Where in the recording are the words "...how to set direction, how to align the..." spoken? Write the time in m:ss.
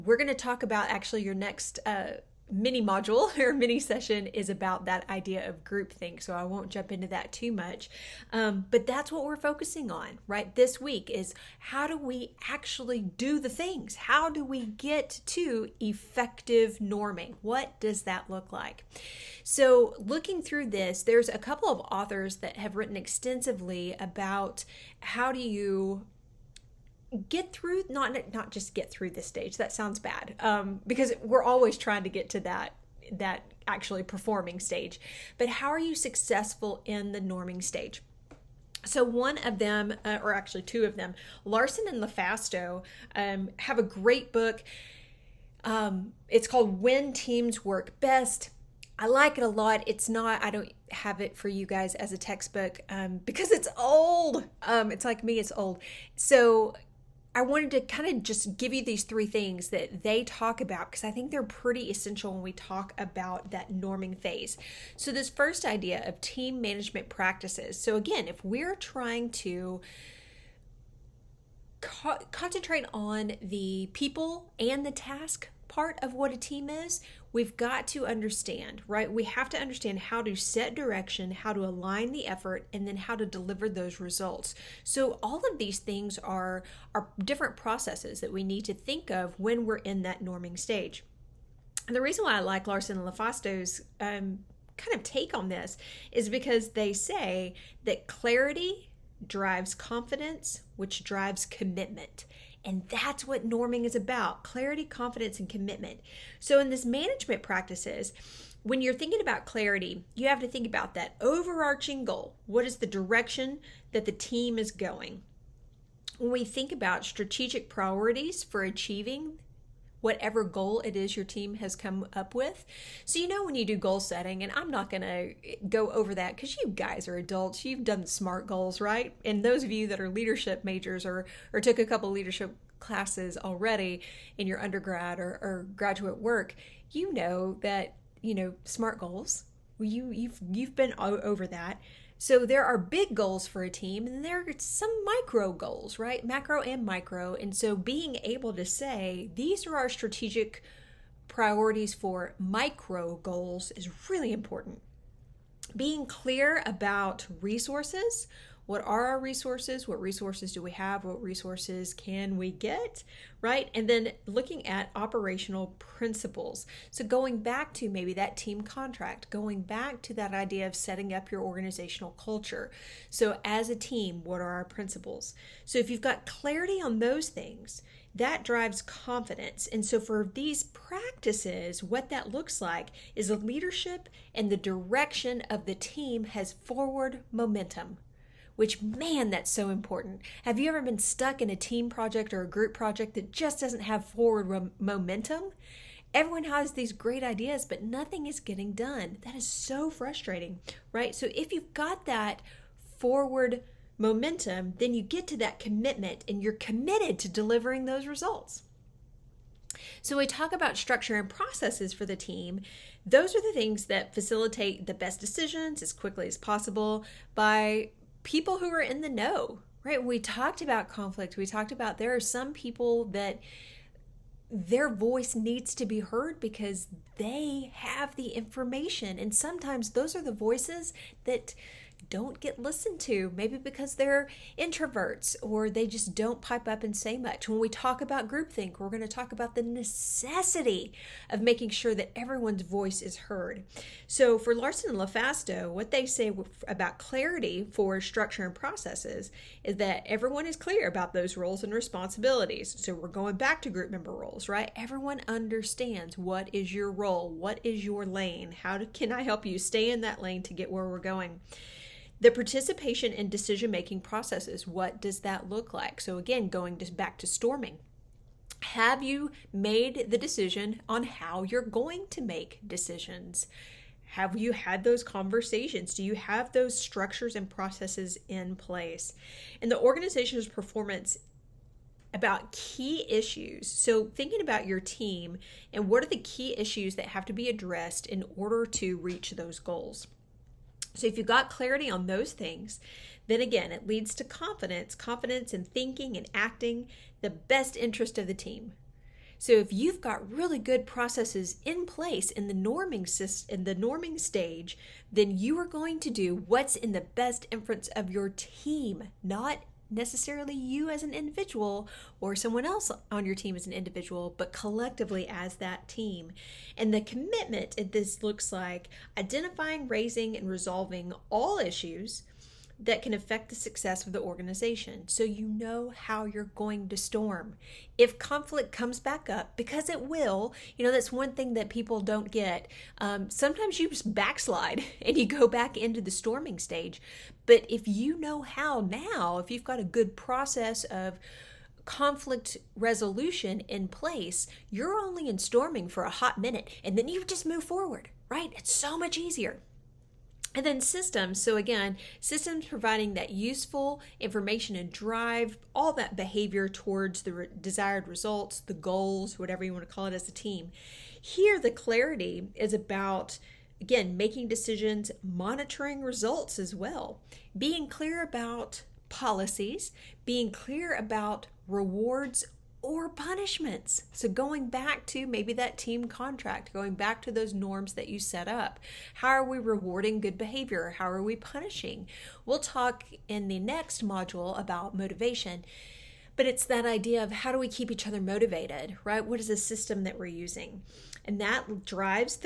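1:19.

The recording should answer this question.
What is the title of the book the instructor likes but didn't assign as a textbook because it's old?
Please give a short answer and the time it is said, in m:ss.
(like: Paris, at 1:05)
When Teams Work Best, at 0:46.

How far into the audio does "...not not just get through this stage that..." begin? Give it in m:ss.
0:27.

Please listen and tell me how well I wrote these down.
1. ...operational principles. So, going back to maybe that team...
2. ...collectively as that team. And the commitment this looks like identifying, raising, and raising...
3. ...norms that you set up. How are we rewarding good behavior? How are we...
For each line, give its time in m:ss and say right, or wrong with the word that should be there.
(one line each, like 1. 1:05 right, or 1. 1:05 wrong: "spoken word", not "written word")
1. 2:44 right
2. 5:14 wrong: "resolving", not "raising"
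3. 6:17 right.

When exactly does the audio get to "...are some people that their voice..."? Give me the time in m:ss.
3:42.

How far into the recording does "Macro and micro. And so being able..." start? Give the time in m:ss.
2:26.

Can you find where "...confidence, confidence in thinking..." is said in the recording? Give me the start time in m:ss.
4:54.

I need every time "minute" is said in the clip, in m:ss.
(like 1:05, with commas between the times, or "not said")
5:46.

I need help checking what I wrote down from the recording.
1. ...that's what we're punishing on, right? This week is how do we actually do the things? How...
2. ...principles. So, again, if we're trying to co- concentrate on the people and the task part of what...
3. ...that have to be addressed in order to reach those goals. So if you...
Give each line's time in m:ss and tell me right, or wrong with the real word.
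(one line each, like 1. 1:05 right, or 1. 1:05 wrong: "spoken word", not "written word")
1. 0:08 wrong: "focusing", not "punishing"
2. 1:07 wrong: "practices", not "principles"
3. 4:46 right.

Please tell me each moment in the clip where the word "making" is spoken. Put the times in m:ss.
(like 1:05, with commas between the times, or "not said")
4:01, 4:23, 6:04.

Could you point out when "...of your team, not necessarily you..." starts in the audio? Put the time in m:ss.
5:07.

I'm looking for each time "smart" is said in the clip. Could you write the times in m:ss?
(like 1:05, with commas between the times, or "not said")
2:08, 2:18.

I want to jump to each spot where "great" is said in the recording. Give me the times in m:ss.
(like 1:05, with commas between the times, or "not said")
0:43, 3:16.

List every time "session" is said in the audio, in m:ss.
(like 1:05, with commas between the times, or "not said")
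0:03.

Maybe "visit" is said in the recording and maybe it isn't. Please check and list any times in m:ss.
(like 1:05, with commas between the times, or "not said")
not said.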